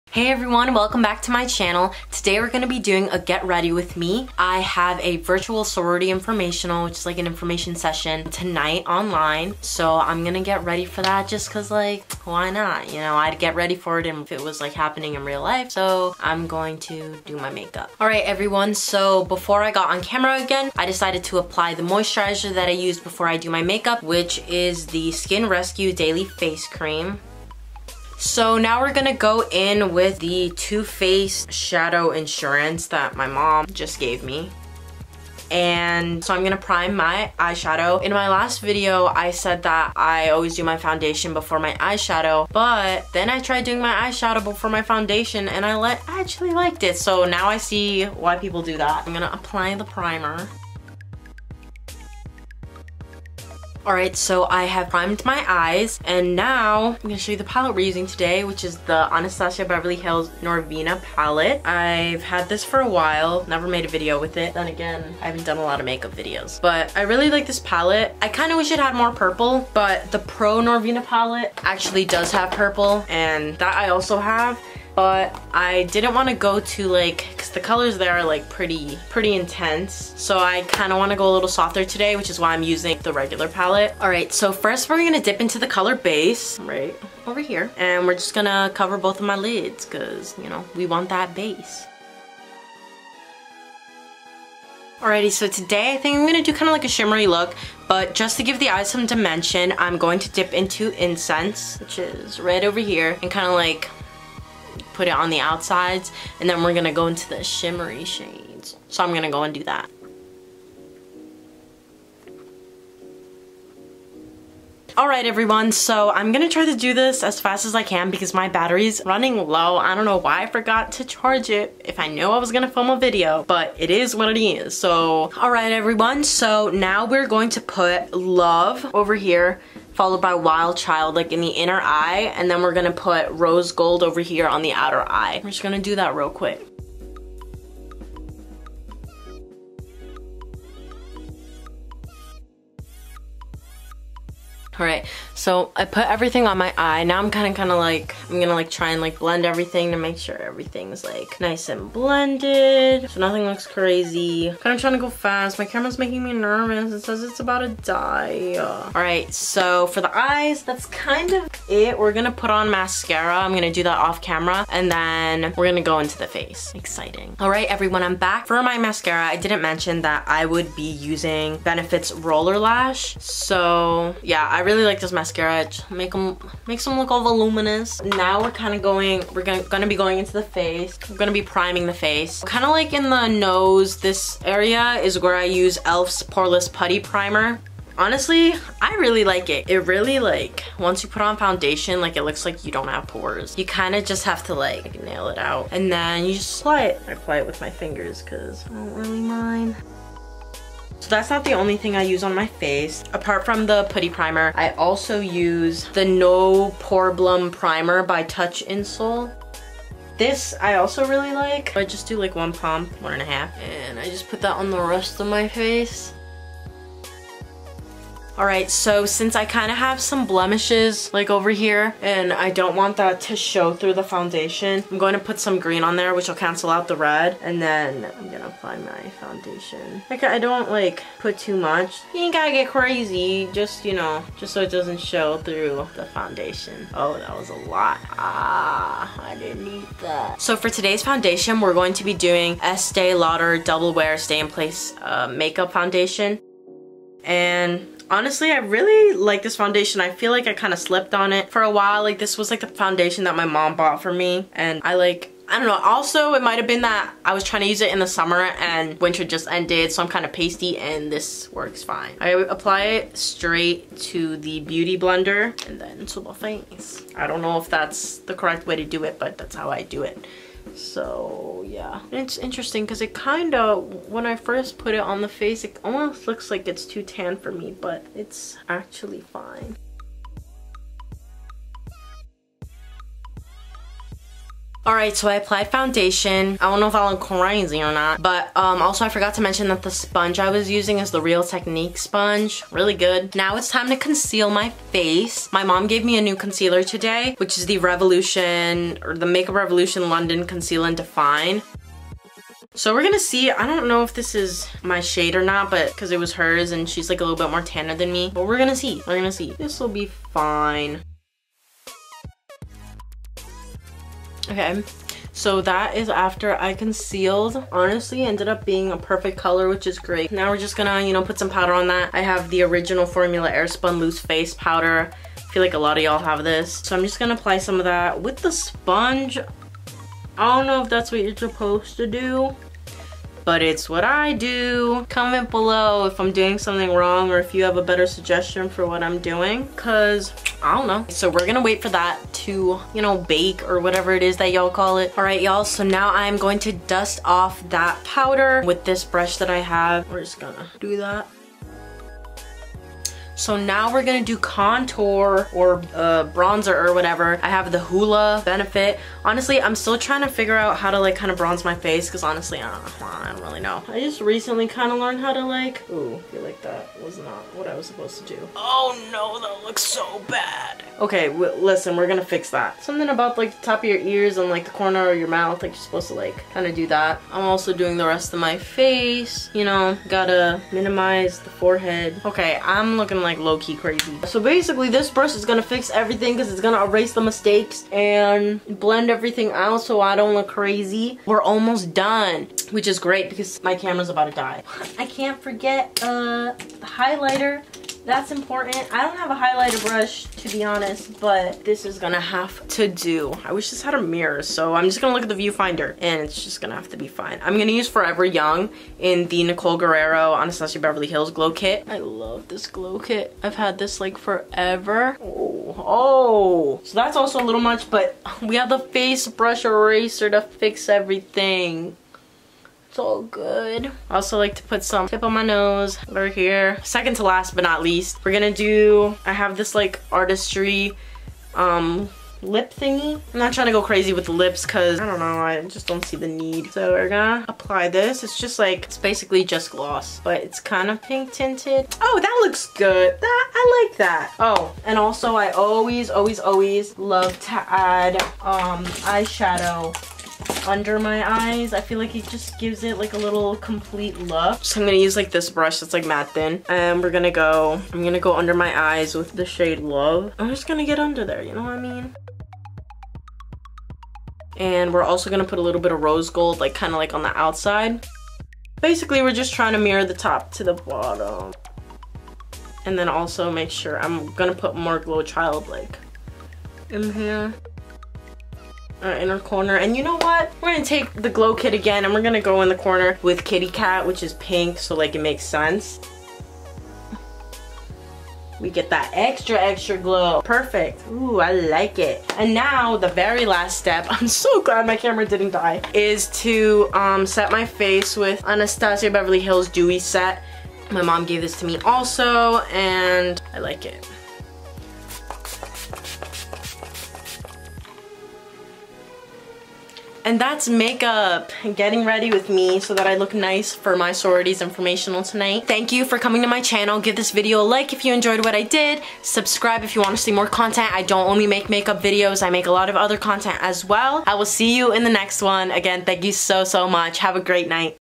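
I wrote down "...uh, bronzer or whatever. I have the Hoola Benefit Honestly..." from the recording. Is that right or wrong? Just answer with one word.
right.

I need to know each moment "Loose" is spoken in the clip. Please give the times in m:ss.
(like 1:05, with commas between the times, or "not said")
5:23.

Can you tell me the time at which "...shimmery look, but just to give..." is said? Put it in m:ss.
1:36.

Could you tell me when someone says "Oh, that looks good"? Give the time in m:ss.
7:22.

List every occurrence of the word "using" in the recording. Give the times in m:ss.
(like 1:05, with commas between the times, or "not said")
0:57, 1:22, 2:50, 4:50.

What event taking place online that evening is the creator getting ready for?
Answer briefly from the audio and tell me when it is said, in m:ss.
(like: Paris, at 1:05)
Virtual sorority informational, at 0:05.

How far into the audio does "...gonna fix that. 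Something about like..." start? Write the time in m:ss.
6:12.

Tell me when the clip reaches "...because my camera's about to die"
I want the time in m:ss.
6:33.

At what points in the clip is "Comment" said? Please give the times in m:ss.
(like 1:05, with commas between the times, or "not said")
5:35.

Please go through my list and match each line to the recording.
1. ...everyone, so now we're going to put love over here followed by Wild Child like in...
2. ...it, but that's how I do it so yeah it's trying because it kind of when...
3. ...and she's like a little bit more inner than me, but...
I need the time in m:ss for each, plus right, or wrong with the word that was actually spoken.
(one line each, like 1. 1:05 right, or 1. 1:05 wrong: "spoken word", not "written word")
1. 2:05 right
2. 4:29 wrong: "interesting", not "trying"
3. 5:06 wrong: "tanner", not "inner".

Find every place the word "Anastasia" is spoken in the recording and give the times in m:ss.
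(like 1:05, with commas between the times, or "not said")
0:59, 6:50, 8:18.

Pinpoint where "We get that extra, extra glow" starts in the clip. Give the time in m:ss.
8:08.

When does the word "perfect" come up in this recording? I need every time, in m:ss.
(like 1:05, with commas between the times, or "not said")
5:18, 8:10.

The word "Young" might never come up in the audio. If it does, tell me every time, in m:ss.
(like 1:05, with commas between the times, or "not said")
6:48.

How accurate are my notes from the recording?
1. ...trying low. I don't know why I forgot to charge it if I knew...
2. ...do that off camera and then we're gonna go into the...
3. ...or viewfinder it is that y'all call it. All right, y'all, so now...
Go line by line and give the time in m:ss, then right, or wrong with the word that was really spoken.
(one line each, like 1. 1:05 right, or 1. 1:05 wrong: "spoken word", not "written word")
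1. 1:59 wrong: "running", not "trying"
2. 2:43 right
3. 5:43 wrong: "whatever", not "viewfinder".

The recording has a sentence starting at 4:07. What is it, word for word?
And honestly, I really like this foundation.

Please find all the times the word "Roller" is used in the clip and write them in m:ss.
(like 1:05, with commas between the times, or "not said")
2:52.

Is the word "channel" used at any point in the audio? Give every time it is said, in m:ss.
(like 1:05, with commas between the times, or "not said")
0:01, 8:36.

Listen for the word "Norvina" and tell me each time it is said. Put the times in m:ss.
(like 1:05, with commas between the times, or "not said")
1:00, 1:10.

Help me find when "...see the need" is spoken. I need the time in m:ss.
7:16.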